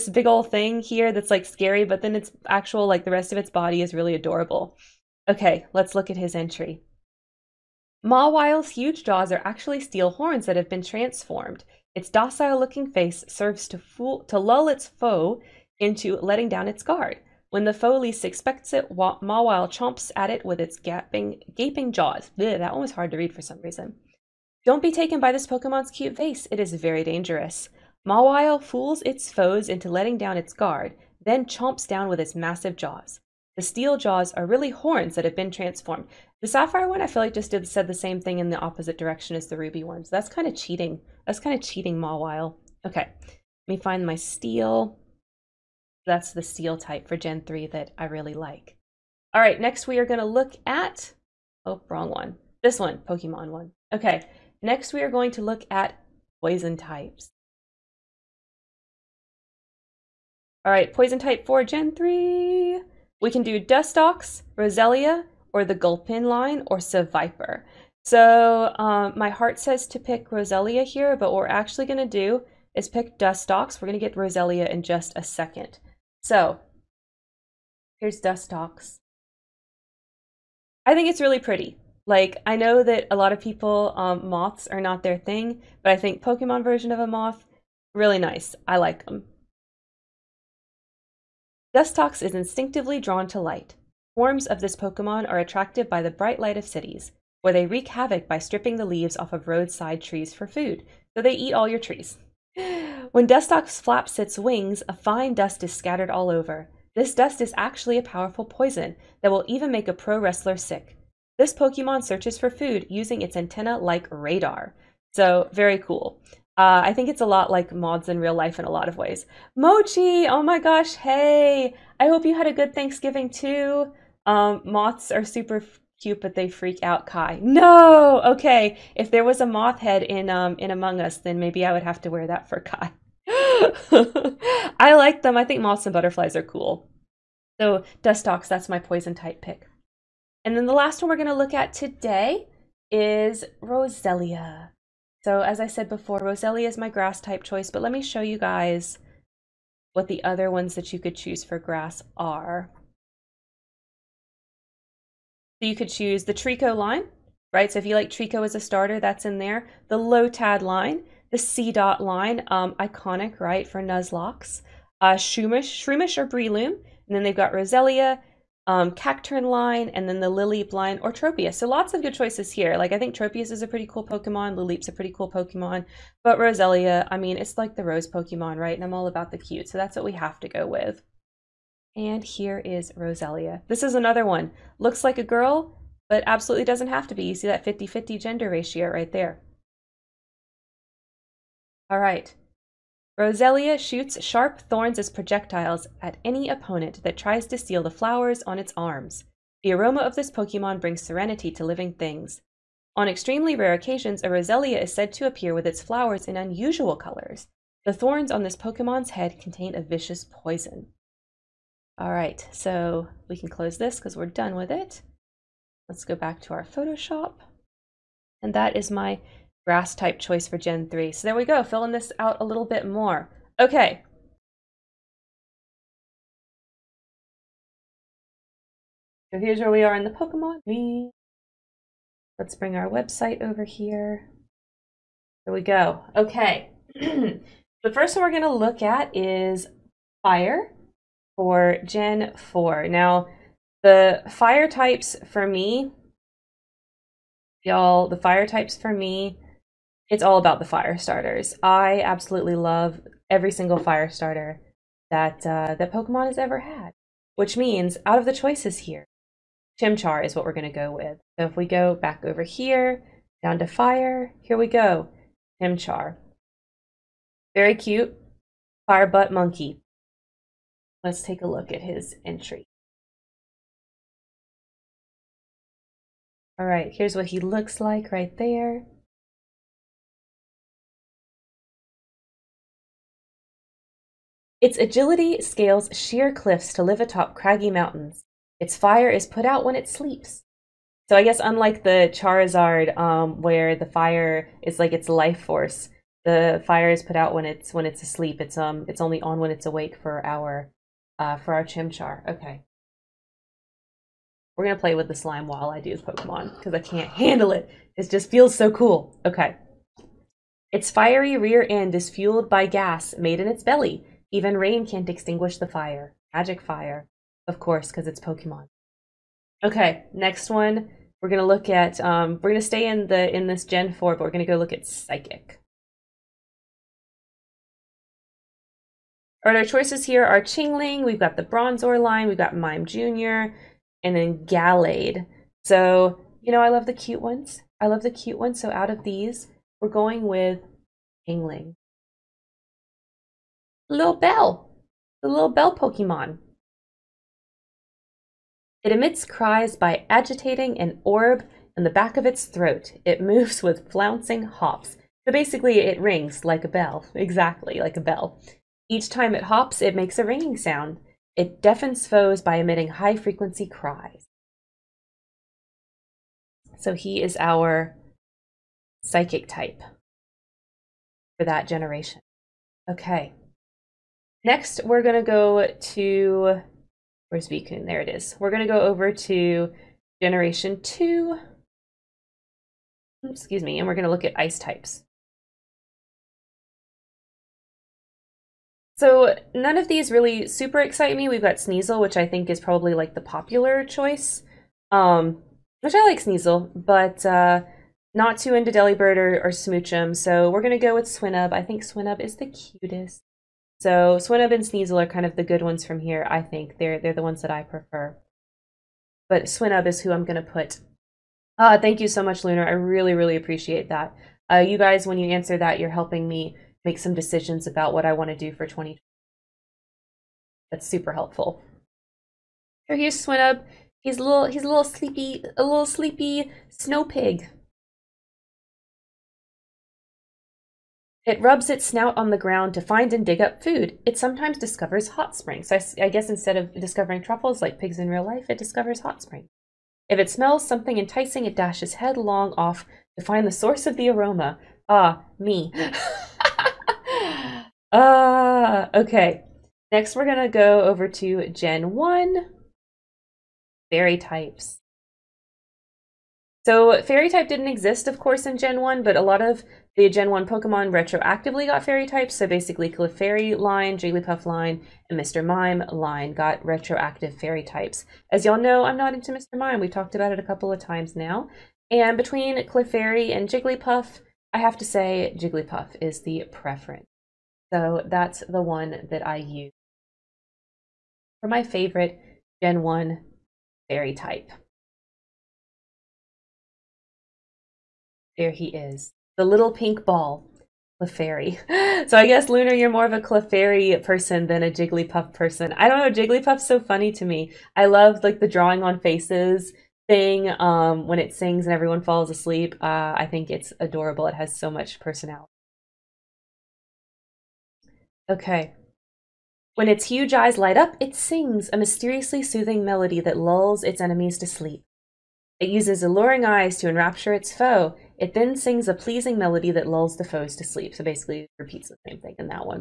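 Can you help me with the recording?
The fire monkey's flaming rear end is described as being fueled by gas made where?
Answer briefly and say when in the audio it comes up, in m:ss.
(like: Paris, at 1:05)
In its belly, at 5:13.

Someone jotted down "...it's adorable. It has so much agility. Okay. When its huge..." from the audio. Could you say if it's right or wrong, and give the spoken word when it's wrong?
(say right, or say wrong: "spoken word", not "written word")
wrong: "personality", not "agility".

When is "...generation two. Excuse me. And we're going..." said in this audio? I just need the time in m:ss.
6:20.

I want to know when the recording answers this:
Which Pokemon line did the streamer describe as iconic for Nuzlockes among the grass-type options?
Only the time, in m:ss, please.
2:41.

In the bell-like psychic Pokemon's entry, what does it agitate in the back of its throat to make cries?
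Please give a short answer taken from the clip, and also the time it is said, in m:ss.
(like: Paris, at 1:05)
An orb, at 5:50.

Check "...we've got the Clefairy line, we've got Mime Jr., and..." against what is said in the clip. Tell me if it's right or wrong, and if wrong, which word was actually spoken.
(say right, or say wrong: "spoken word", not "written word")
wrong: "Bronzor", not "Clefairy".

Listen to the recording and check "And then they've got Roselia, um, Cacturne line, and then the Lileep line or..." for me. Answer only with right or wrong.
right.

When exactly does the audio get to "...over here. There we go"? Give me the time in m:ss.
3:53.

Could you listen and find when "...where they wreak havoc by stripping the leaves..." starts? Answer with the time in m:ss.
1:37.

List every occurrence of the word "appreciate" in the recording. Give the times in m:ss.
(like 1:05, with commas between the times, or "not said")
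6:53.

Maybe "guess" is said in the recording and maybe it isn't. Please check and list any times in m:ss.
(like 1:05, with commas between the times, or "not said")
4:51, 7:16, 8:12.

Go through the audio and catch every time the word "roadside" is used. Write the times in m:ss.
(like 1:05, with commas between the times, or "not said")
1:39.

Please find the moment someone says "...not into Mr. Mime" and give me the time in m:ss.
7:48.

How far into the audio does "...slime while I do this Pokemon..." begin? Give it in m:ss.
5:05.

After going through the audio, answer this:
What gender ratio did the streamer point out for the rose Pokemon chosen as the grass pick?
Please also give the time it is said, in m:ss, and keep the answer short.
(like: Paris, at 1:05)
50-50, at 3:07.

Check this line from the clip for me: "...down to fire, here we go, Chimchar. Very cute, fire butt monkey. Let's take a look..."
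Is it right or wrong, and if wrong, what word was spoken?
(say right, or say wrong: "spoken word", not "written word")
right.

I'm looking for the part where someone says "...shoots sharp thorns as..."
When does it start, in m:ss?
3:13.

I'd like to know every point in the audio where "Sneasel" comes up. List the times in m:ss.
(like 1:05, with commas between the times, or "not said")
6:31, 6:36, 6:44.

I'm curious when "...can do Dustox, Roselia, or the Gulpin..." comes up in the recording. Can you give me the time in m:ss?
1:03.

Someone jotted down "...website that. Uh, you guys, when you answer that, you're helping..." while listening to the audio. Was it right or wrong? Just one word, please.
wrong.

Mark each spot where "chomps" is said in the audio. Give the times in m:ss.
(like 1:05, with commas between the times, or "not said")
0:19, 0:31.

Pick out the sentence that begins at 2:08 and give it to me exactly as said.
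If there was a moth head in um in Among Us, then maybe I would have to wear that for Kai.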